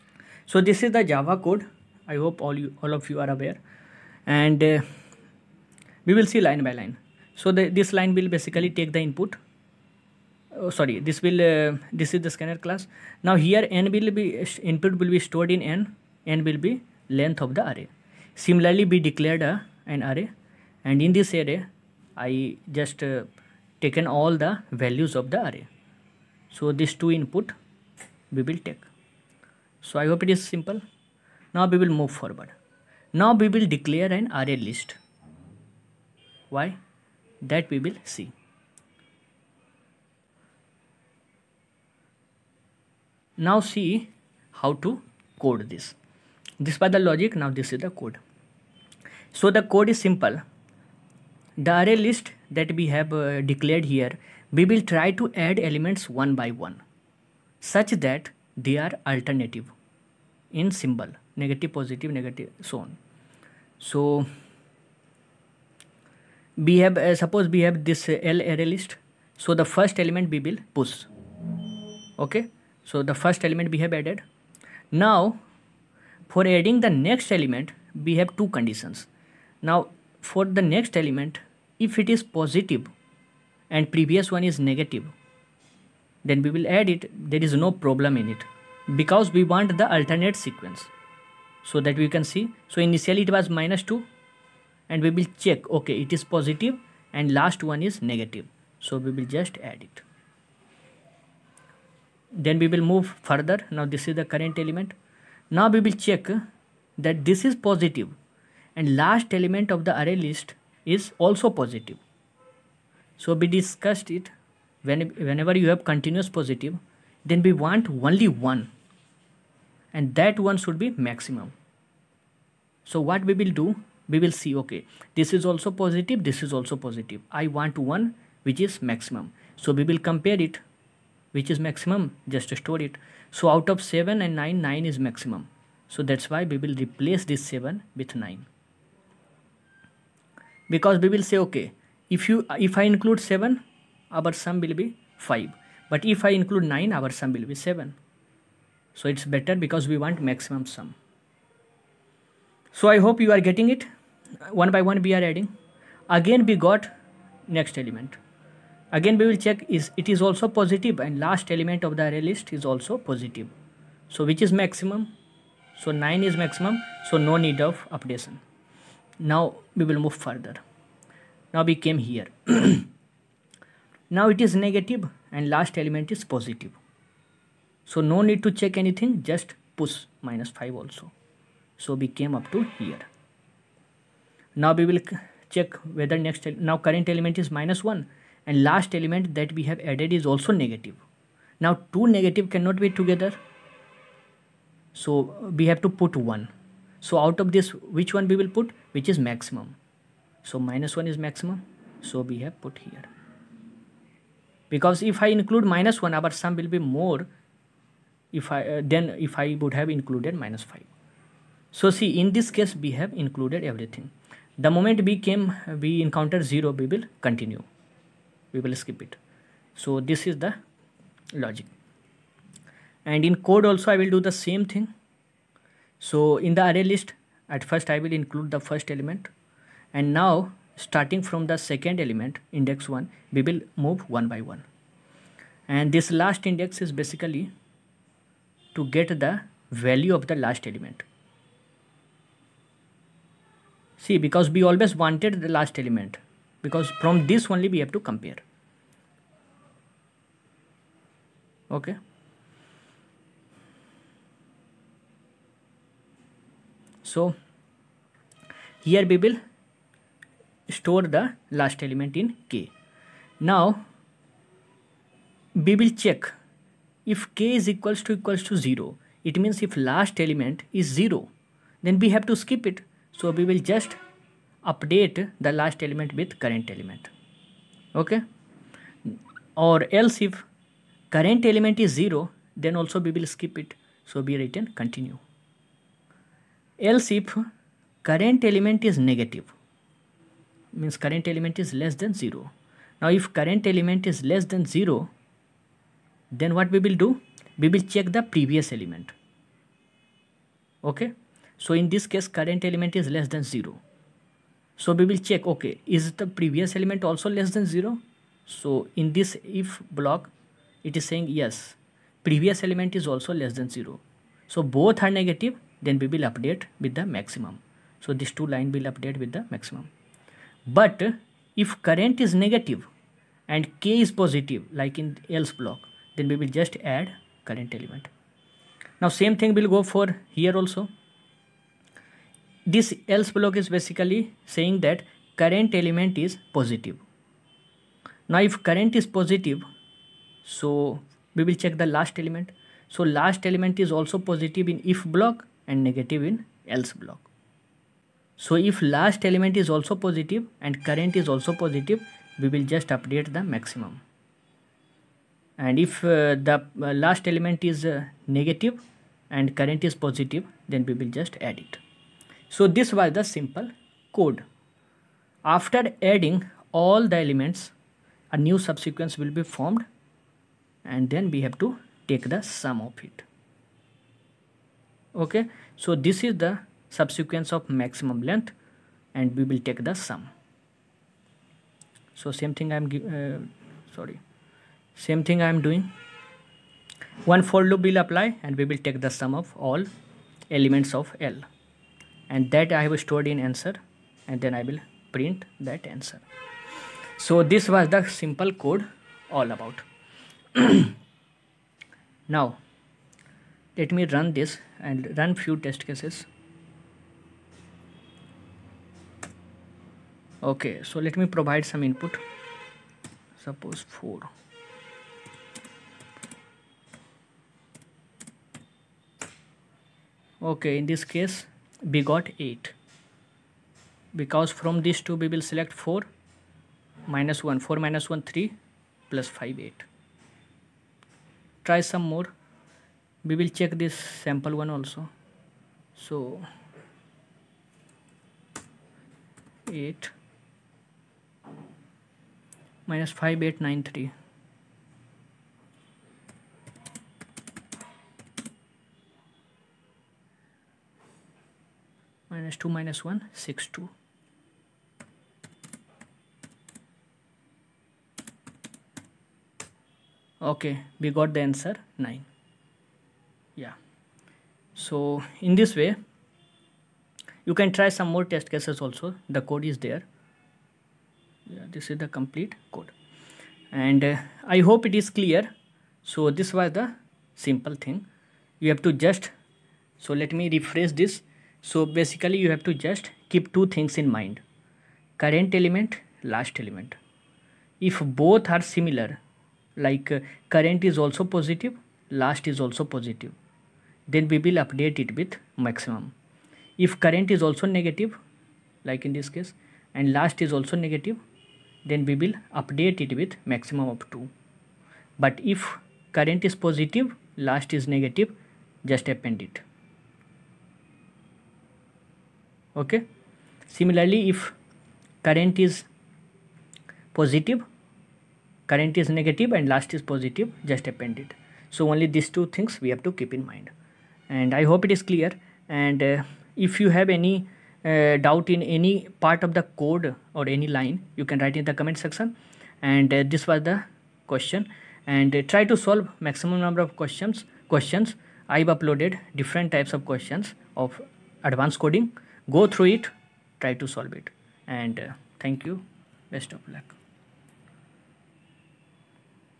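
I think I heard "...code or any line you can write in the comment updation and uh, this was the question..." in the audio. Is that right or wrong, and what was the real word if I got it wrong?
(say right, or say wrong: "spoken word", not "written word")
wrong: "section", not "updation".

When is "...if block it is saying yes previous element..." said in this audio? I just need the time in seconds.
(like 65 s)
309 s.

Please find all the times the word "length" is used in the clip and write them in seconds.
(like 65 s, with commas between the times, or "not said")
17 s, 378 s.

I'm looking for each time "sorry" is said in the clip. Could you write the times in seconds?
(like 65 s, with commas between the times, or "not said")
10 s, 383 s.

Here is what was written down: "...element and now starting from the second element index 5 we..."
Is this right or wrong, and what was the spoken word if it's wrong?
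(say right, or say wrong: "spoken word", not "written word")
wrong: "1", not "5".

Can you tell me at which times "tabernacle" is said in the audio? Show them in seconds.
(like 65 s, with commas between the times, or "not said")
not said.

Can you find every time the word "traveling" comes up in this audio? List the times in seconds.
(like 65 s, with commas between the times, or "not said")
not said.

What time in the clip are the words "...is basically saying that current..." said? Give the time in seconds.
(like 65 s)
333 s.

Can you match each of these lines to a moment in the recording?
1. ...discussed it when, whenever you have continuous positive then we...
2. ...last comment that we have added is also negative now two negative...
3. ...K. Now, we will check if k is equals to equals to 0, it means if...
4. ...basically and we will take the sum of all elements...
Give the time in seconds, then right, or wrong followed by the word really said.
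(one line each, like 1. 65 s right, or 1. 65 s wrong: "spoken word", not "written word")
1. 113 s right
2. 188 s wrong: "element", not "comment"
3. 262 s right
4. 387 s wrong: "apply", not "basically".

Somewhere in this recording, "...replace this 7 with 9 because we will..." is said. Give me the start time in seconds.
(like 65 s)
136 s.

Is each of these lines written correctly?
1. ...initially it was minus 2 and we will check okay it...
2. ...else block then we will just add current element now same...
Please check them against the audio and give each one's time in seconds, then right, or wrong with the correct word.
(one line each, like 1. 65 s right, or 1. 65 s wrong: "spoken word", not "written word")
1. 92 s right
2. 325 s right.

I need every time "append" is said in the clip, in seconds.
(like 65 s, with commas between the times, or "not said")
509 s, 520 s.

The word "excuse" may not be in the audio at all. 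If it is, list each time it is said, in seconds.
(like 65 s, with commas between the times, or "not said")
not said.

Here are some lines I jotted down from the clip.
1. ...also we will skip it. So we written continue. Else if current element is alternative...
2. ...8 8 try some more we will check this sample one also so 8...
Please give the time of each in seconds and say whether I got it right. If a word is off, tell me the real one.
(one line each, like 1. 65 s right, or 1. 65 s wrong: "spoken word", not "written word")
1. 282 s wrong: "negative", not "alternative"
2. 429 s wrong: "5", not "8".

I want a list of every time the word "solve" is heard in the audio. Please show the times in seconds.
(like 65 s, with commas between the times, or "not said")
535 s, 543 s.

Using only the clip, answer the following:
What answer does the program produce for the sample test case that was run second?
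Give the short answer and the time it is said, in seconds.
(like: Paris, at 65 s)
9, at 461 s.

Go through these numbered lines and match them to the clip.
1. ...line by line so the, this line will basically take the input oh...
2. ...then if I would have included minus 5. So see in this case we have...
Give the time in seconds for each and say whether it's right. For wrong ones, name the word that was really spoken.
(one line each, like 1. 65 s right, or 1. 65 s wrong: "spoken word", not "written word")
1. 6 s right
2. 208 s right.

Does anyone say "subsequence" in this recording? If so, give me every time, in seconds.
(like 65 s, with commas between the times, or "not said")
368 s, 376 s.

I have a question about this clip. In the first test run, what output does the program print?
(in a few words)
8.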